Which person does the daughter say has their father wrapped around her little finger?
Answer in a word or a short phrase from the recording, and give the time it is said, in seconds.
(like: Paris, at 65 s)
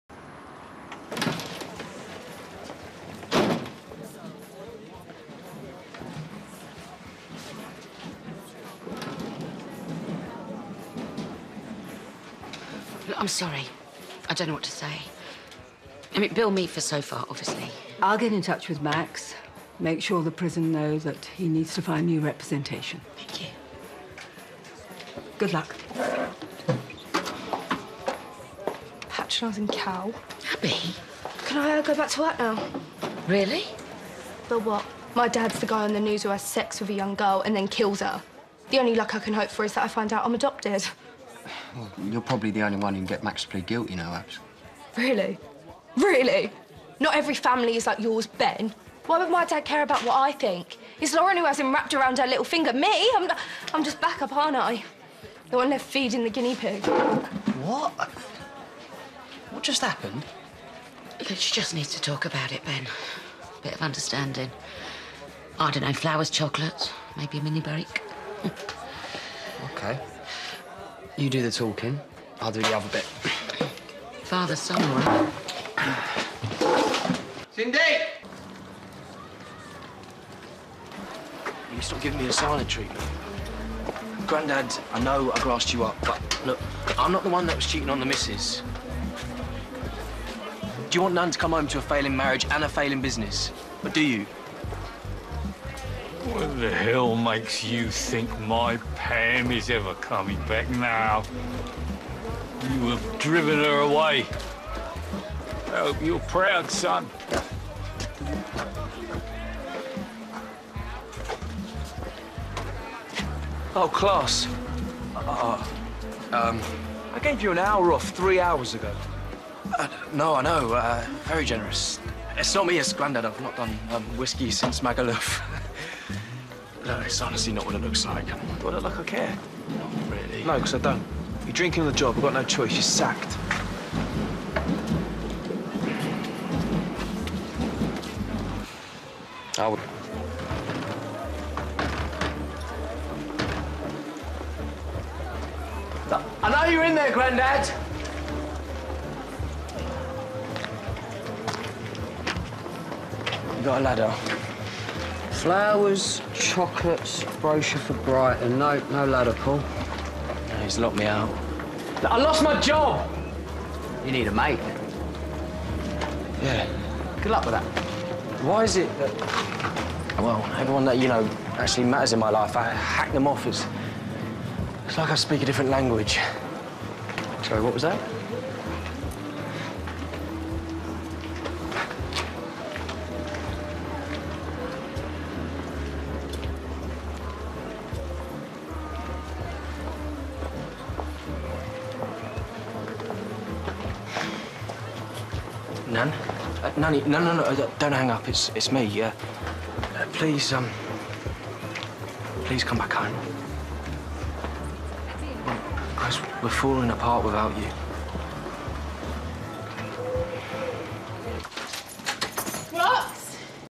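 Lauren, at 51 s.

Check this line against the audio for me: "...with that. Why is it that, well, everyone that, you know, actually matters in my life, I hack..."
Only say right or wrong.
right.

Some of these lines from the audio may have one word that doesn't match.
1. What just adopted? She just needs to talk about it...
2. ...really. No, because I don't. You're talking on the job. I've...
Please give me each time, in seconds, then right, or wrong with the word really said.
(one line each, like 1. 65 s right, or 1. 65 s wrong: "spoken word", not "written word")
1. 59 s wrong: "happened", not "adopted"
2. 130 s wrong: "drinking", not "talking".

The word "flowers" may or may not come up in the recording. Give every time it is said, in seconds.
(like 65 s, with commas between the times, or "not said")
65 s, 155 s.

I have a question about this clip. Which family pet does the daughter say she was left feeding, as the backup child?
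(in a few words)
guinea pig.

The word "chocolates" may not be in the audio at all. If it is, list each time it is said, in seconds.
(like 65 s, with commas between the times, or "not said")
66 s, 156 s.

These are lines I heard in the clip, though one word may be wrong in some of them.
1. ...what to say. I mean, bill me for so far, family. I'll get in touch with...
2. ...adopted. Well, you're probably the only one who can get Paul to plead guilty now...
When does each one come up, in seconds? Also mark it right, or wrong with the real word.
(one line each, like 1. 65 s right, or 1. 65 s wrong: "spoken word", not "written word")
1. 14 s wrong: "obviously", not "family"
2. 40 s wrong: "Max", not "Paul".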